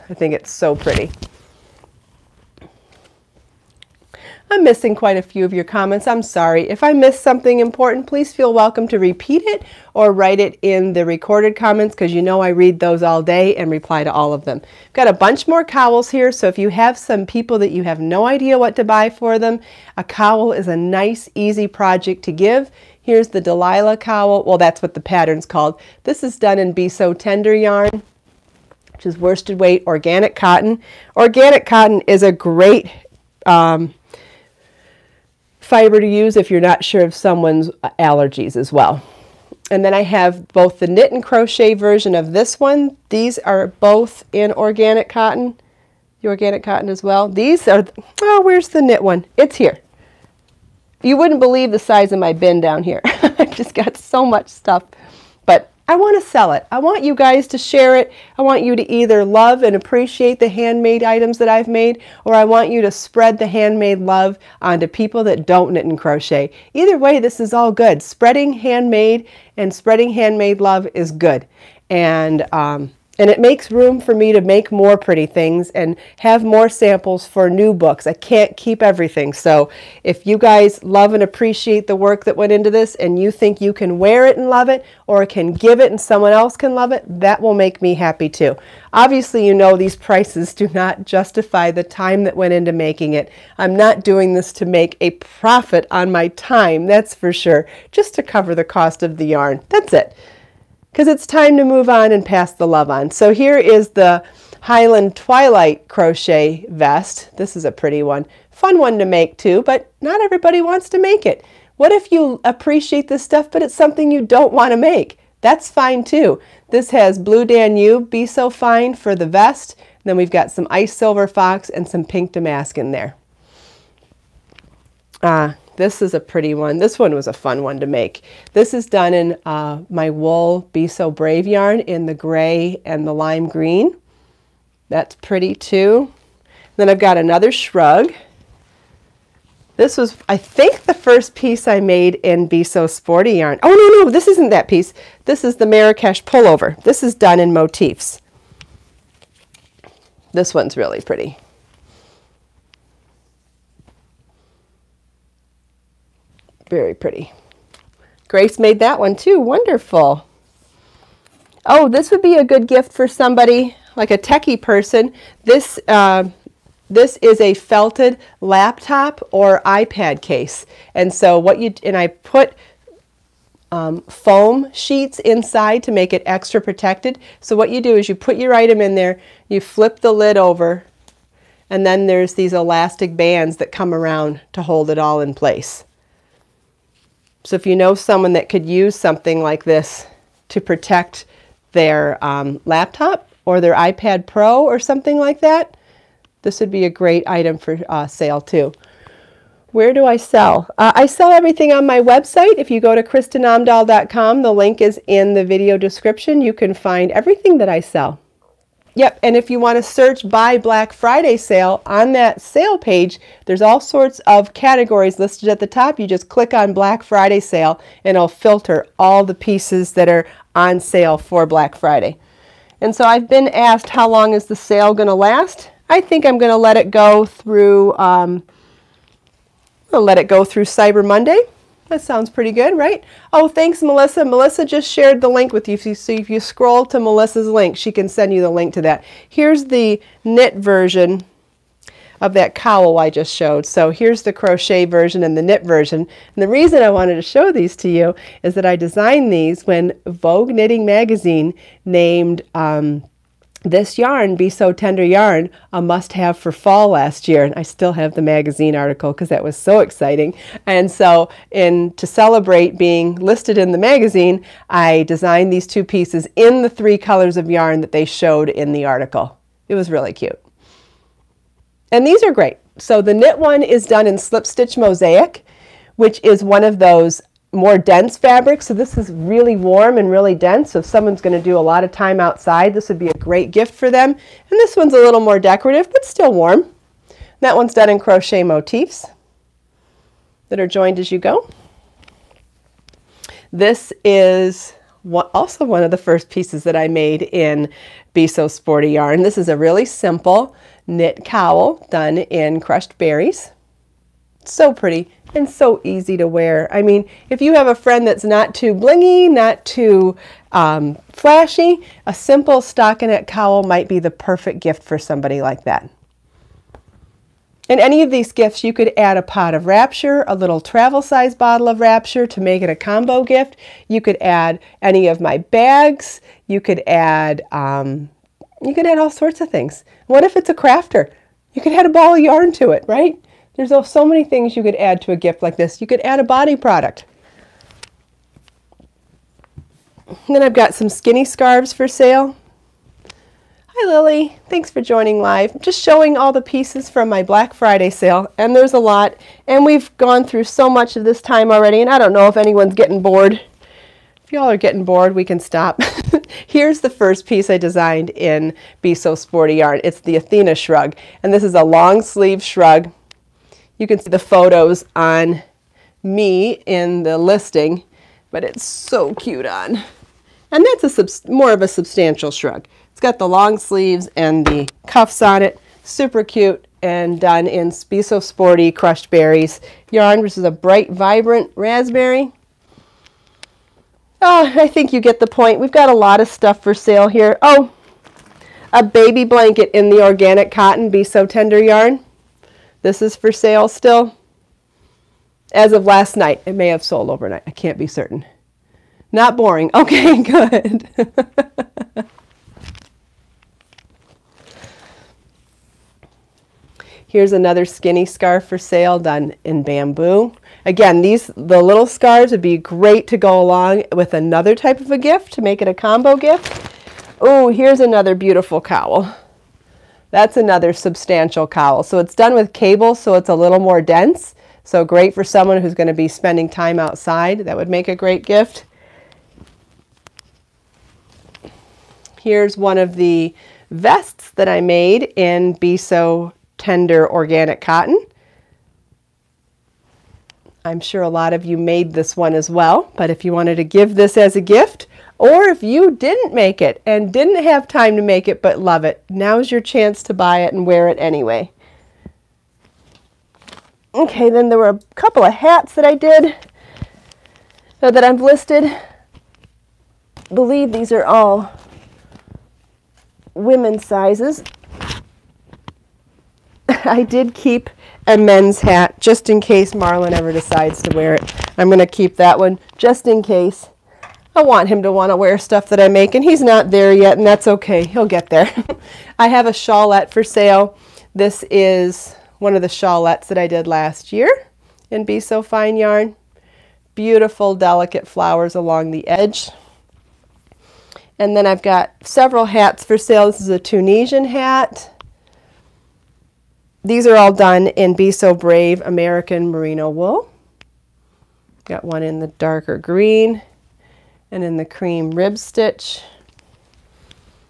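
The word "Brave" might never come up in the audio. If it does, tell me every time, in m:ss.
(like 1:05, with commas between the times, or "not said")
2:11, 8:18.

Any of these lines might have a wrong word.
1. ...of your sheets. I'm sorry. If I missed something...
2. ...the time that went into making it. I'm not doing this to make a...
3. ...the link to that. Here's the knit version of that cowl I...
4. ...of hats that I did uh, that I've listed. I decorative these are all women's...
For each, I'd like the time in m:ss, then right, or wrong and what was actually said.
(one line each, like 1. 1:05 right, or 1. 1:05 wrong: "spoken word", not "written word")
1. 0:05 wrong: "comments", not "sheets"
2. 1:31 right
3. 3:58 right
4. 7:35 wrong: "believe", not "decorative".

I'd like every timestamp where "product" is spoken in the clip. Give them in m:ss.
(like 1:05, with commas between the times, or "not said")
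5:36.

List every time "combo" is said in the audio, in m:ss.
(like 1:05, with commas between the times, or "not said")
5:22, 6:55.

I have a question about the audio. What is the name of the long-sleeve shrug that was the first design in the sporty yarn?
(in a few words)
Athena.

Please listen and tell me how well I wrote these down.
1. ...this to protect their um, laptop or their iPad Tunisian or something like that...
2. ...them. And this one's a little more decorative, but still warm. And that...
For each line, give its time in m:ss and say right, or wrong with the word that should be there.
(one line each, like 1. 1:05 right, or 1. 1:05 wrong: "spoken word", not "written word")
1. 3:09 wrong: "Pro", not "Tunisian"
2. 4:43 right.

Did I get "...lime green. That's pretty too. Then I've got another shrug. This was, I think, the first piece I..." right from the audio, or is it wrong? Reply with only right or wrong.
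right.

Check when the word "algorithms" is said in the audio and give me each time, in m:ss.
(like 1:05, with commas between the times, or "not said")
not said.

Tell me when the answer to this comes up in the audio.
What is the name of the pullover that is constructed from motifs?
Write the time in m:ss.
2:25.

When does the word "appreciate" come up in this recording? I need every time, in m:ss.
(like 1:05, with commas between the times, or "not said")
0:59, 1:21, 1:52.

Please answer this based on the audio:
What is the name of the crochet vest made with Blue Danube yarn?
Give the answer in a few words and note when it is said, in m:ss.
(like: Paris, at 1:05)
Highland Twilight, at 1:44.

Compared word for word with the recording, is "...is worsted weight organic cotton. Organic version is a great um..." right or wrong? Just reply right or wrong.
wrong.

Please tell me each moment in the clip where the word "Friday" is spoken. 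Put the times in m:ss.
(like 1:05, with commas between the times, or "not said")
3:30, 3:37, 3:41, 5:47.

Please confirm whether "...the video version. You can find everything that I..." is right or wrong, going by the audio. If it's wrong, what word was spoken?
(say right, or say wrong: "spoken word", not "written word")
wrong: "description", not "version".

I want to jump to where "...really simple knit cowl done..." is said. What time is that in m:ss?
4:59.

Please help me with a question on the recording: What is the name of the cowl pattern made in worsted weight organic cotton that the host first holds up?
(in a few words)
Delilah.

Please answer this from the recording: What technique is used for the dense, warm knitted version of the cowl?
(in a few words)
slip stitch mosaic.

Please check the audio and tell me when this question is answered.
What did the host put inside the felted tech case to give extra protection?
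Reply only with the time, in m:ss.
2:54.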